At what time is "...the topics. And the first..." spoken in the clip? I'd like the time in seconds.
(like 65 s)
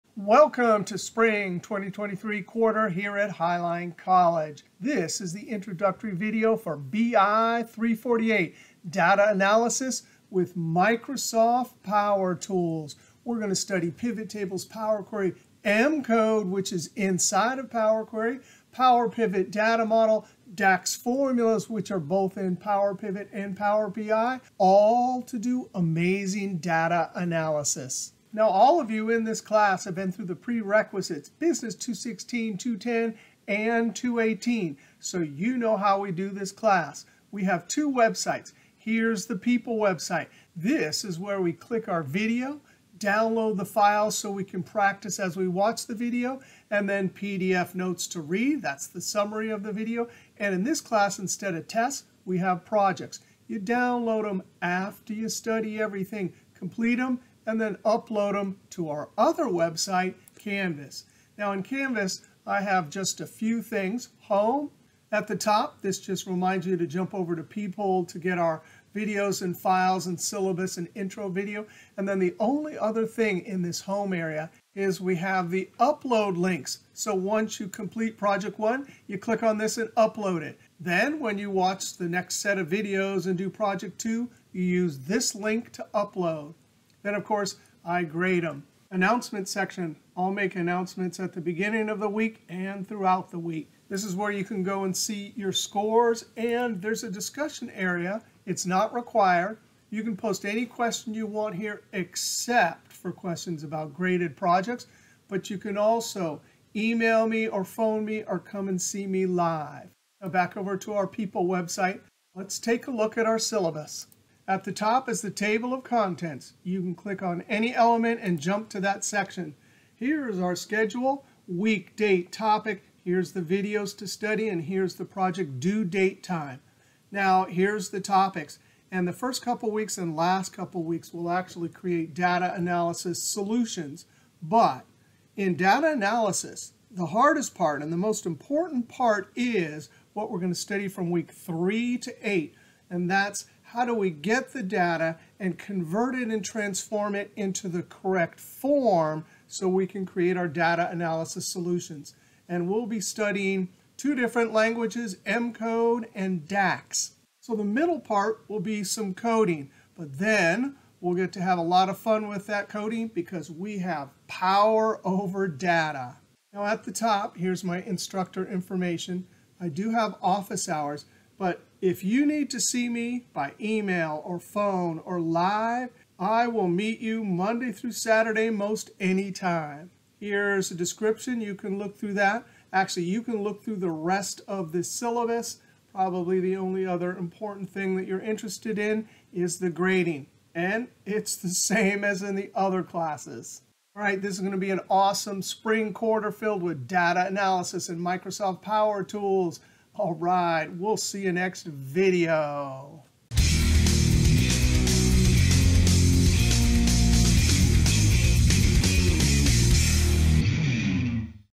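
127 s.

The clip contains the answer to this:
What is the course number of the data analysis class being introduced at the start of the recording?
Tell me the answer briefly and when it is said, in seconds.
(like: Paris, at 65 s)
BI 348, at 6 s.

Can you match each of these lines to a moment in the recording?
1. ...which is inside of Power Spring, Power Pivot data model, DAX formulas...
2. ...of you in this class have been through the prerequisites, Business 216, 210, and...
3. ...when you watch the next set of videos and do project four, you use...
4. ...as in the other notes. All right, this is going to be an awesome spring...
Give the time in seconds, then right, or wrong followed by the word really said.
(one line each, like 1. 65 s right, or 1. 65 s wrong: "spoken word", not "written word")
1. 16 s wrong: "Query", not "Spring"
2. 28 s right
3. 81 s wrong: "two", not "four"
4. 192 s wrong: "classes", not "notes".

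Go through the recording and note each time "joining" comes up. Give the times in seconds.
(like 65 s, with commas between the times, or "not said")
not said.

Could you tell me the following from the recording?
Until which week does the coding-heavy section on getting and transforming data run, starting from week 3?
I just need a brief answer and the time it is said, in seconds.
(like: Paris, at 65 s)
Week 8, at 142 s.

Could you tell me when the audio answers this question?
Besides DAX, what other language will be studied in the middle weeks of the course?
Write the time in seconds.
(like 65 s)
155 s.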